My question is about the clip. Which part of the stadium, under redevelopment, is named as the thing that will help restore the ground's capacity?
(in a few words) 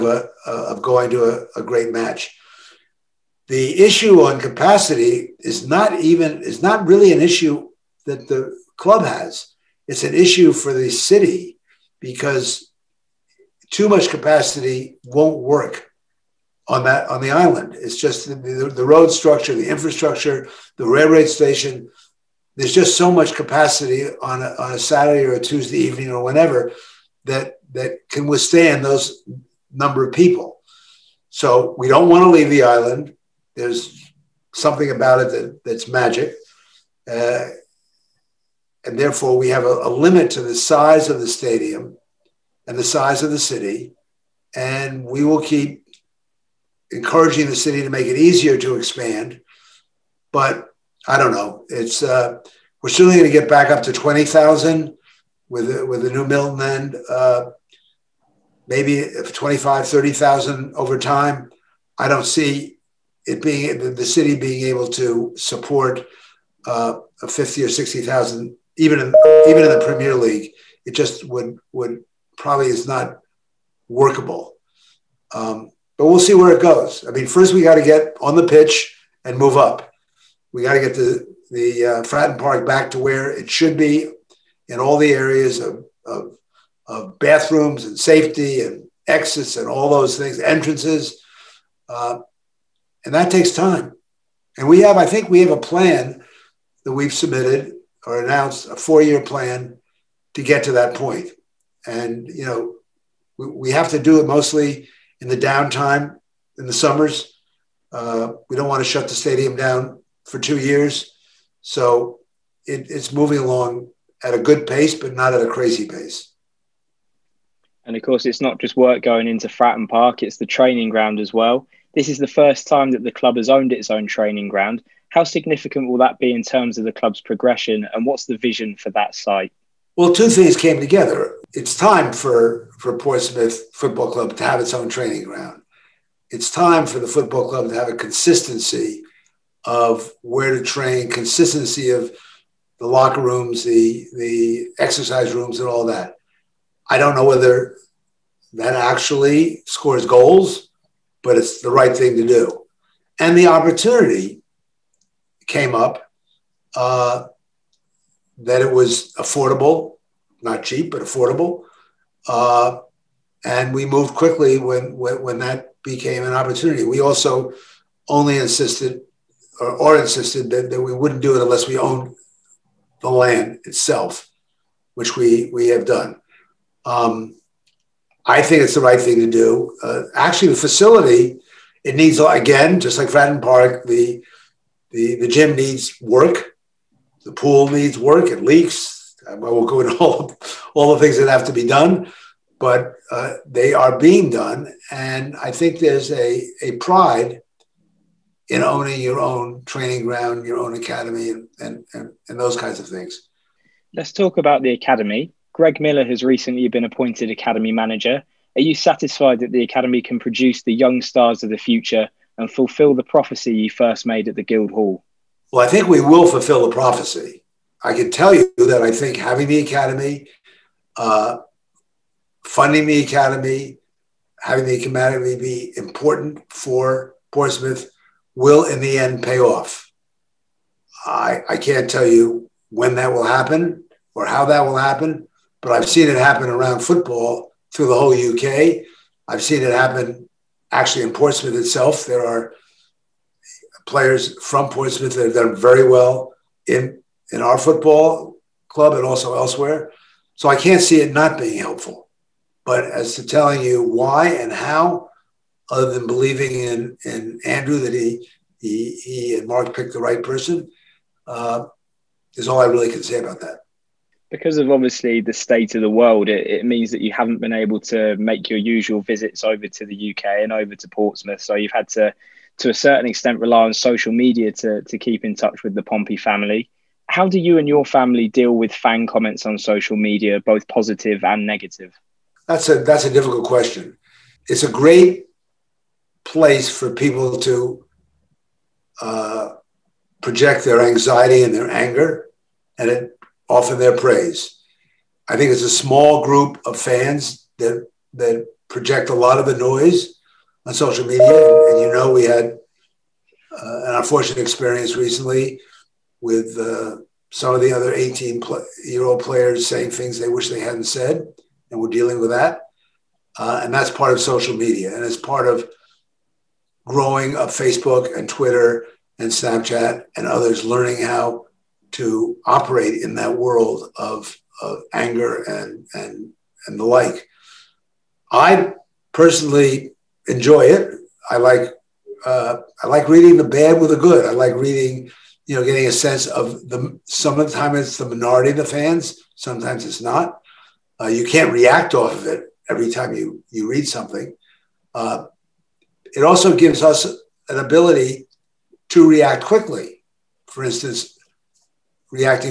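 Milton end.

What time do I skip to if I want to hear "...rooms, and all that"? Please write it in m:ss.
2:25.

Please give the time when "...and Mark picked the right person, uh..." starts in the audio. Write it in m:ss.
4:19.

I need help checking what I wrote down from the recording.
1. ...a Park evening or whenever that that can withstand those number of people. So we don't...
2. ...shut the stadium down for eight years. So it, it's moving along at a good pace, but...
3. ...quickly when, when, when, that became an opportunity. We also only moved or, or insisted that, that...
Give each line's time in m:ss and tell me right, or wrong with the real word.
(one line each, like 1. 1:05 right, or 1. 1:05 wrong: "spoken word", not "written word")
1. 0:25 wrong: "Tuesday", not "Park"
2. 1:48 wrong: "two", not "eight"
3. 2:44 wrong: "insisted", not "moved".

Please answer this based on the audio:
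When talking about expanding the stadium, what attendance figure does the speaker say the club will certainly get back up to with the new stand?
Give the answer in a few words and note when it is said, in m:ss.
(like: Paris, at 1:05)
20,000, at 0:53.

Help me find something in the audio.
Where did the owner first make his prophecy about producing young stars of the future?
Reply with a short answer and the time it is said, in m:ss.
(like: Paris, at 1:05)
Guild Hall, at 3:34.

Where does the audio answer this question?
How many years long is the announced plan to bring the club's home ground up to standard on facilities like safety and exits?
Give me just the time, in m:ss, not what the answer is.
1:38.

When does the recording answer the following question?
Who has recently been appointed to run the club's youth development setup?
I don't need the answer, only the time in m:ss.
3:25.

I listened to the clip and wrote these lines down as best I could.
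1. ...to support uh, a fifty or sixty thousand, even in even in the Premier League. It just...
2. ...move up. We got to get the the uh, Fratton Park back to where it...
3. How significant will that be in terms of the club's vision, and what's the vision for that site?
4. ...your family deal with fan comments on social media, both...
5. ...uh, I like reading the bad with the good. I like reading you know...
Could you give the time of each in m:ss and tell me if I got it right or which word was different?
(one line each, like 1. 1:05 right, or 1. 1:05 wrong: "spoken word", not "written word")
1. 1:04 right
2. 1:19 right
3. 2:05 wrong: "progression", not "vision"
4. 4:37 right
5. 5:32 right.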